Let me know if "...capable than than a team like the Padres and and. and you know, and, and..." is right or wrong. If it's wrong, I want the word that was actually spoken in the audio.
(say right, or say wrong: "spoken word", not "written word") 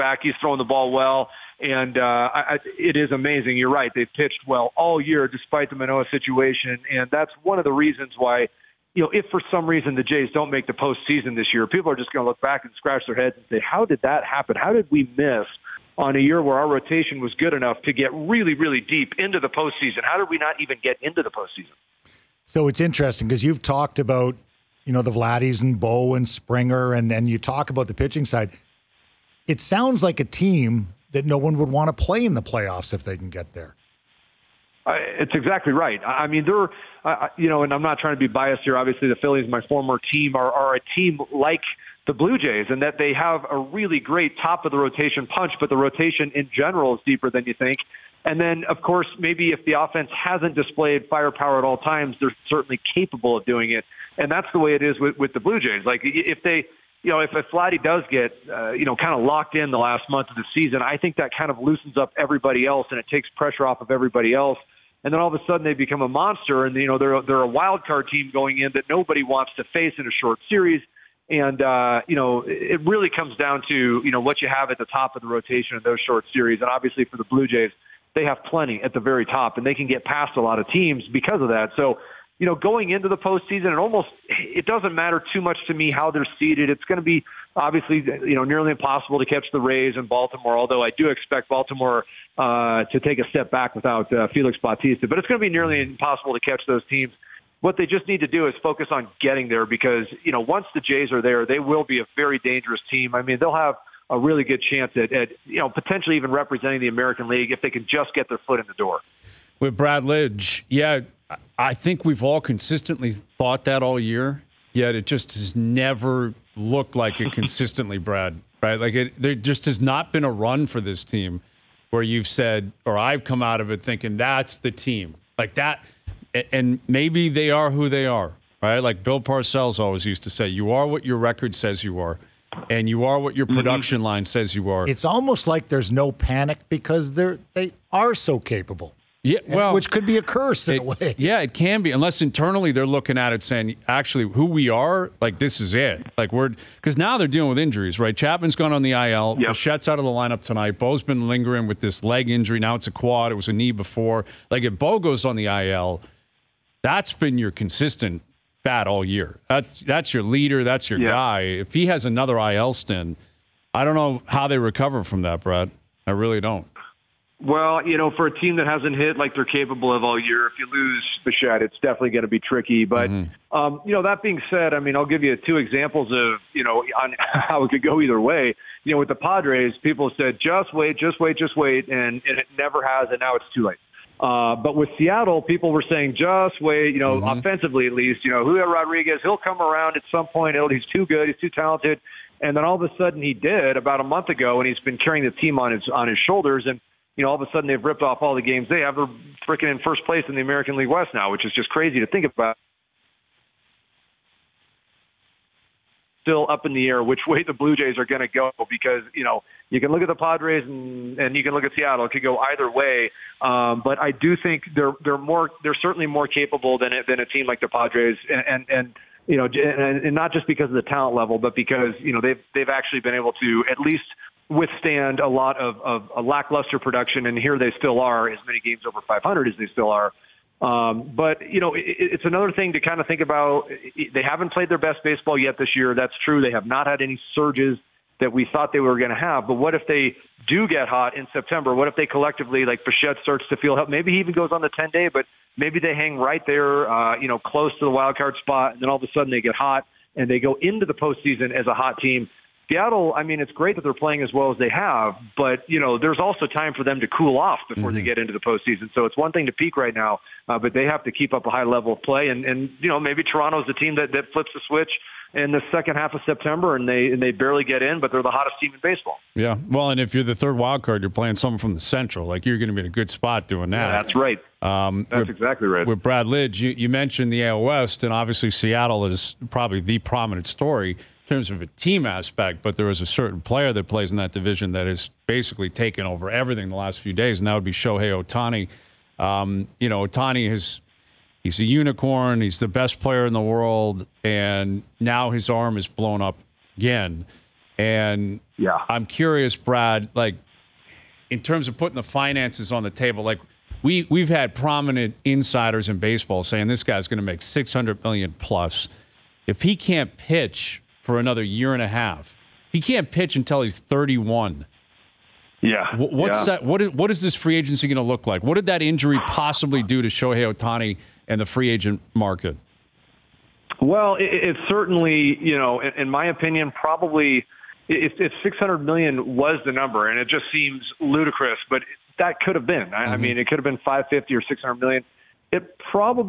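right.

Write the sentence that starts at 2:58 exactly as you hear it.
You know, with the Padres, people said, just wait, just wait, just wait.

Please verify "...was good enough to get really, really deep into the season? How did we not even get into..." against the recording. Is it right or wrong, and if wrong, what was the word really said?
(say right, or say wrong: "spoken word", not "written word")
wrong: "postseason", not "season".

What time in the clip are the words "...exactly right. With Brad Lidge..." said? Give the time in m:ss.
4:35.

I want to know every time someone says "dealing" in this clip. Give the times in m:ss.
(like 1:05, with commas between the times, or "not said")
2:27.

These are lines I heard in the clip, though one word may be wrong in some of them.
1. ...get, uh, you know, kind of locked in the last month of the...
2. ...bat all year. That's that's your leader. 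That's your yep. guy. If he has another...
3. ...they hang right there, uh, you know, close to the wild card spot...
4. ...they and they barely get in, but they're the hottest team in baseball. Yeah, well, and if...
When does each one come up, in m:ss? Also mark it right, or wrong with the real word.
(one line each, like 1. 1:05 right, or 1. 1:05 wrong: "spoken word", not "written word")
1. 0:58 right
2. 2:38 right
3. 4:05 right
4. 4:26 right.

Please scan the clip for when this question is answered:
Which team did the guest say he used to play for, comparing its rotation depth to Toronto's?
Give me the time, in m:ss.
0:39.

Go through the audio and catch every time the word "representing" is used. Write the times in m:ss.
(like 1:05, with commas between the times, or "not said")
1:46.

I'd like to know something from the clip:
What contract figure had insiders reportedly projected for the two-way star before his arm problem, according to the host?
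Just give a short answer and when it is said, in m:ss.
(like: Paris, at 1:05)
600 million, at 5:07.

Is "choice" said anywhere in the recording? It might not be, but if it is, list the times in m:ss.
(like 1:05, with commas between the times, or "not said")
not said.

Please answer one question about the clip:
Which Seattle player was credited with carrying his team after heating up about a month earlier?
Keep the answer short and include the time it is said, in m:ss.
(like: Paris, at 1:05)
Julio Rodriguez, at 3:08.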